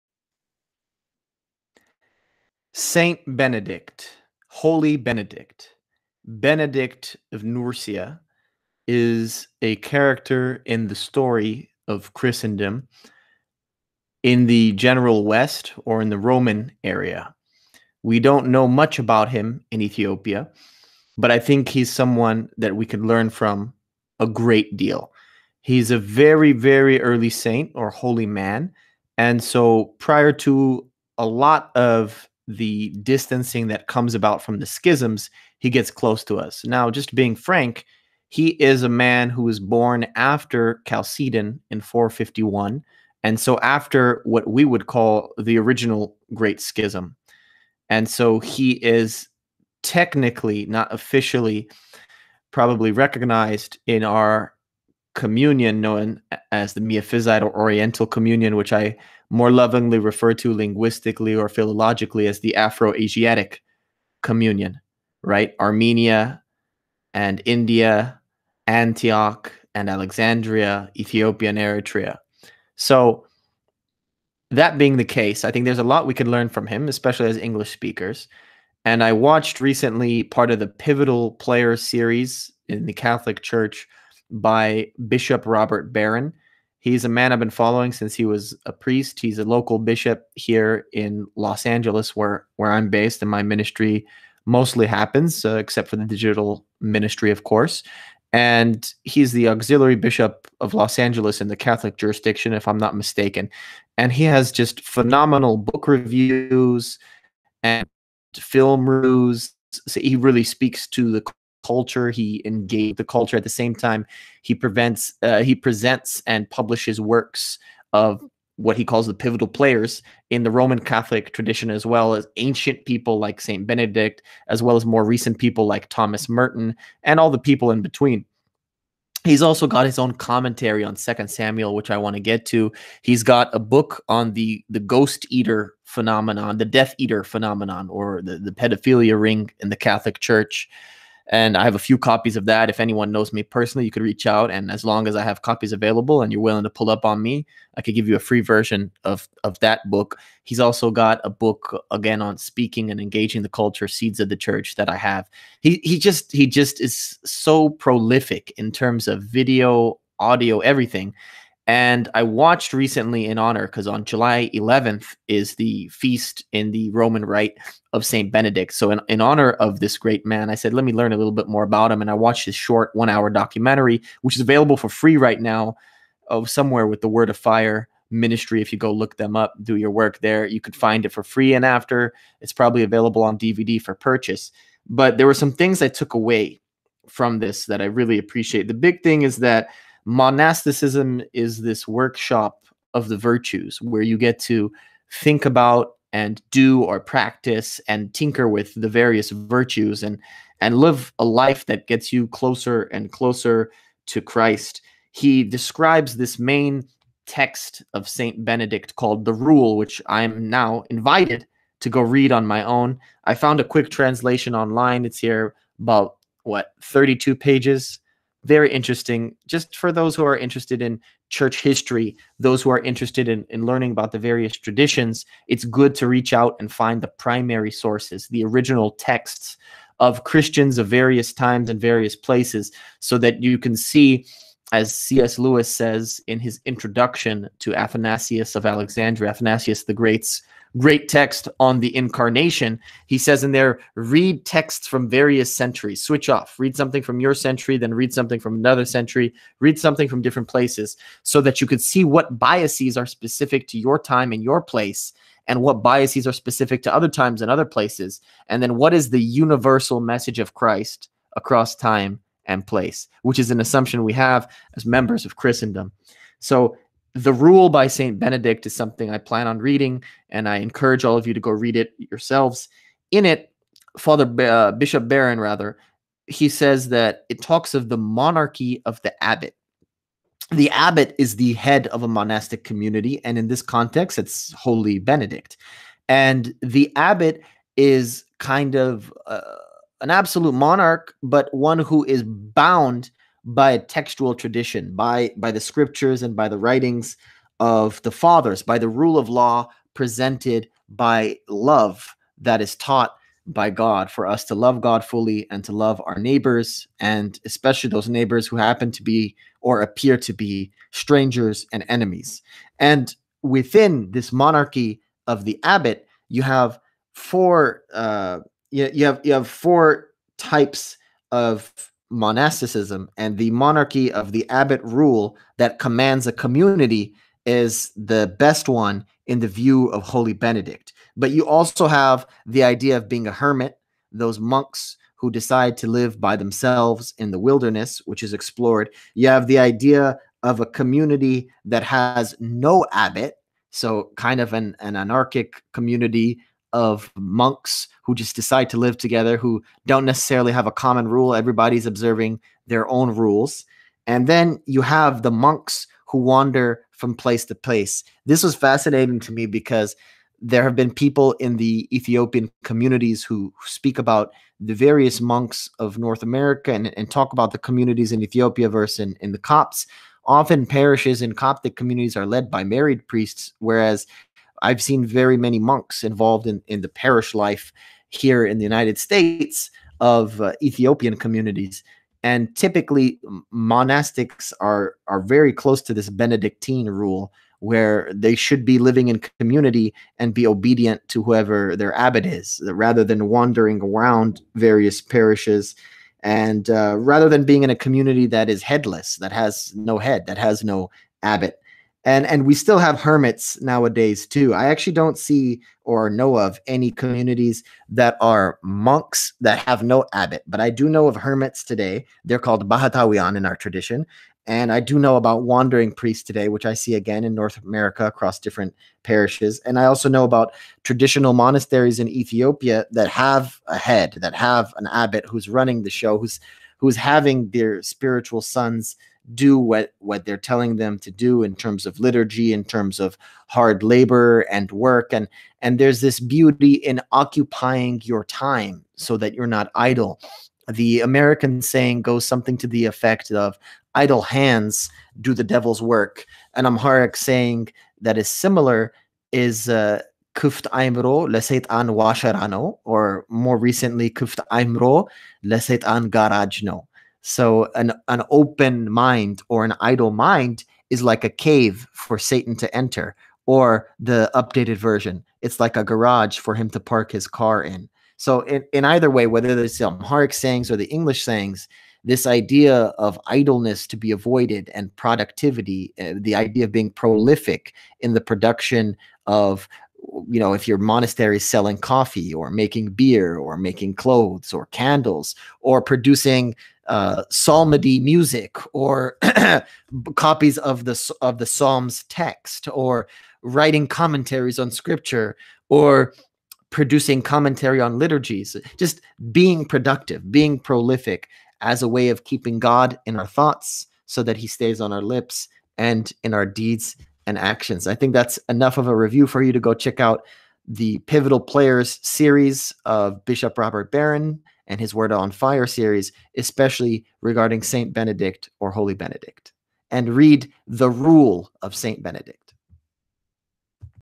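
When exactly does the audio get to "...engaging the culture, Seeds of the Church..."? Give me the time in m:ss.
2:32.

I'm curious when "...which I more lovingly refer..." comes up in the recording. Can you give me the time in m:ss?
0:58.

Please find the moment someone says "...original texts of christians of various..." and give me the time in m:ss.
3:48.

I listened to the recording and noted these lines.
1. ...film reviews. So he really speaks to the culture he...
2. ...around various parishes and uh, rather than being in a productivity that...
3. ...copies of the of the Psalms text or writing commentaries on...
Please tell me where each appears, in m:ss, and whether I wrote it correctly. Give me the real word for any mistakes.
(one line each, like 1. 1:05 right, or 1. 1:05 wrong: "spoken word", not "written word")
1. 1:48 right
2. 6:33 wrong: "community", not "productivity"
3. 8:10 right.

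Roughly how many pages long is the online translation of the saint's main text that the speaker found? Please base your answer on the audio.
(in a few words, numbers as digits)
32.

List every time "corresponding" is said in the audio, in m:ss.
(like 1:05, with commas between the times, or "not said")
not said.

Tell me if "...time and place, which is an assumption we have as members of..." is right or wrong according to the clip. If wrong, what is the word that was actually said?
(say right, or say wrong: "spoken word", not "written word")
right.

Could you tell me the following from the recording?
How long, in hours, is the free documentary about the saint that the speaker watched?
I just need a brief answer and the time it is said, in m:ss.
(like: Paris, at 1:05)
1 hour, at 2:52.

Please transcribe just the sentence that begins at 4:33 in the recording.
In it, Father uh, Bishop Barron, rather, he says that it talks of the monarchy of the abbot.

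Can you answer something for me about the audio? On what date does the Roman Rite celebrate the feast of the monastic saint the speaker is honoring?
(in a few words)
July 11.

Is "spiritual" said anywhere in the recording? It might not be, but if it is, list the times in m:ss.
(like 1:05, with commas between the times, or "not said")
7:07.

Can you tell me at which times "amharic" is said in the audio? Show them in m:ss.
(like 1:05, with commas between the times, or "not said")
7:26, 7:49.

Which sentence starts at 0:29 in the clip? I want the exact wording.
And so prior to a lot of the distancing that comes about from the schisms, he gets close to us.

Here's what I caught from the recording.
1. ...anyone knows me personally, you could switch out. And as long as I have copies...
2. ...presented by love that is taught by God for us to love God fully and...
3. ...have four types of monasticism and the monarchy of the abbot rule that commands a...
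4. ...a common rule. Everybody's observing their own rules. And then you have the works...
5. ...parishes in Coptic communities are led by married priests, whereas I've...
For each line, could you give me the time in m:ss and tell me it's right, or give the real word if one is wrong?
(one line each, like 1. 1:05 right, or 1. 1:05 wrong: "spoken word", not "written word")
1. 2:22 wrong: "reach", not "switch"
2. 4:59 right
3. 5:19 right
4. 5:50 wrong: "monks", not "works"
5. 6:10 right.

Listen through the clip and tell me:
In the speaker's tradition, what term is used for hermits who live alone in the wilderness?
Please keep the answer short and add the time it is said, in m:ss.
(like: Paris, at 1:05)
bahatawian, at 6:52.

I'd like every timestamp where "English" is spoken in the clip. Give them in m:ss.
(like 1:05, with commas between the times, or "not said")
1:17, 7:50.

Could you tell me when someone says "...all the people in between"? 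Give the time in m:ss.
2:07.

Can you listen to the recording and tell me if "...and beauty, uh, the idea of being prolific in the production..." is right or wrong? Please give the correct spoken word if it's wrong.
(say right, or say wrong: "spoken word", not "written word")
wrong: "productivity", not "beauty".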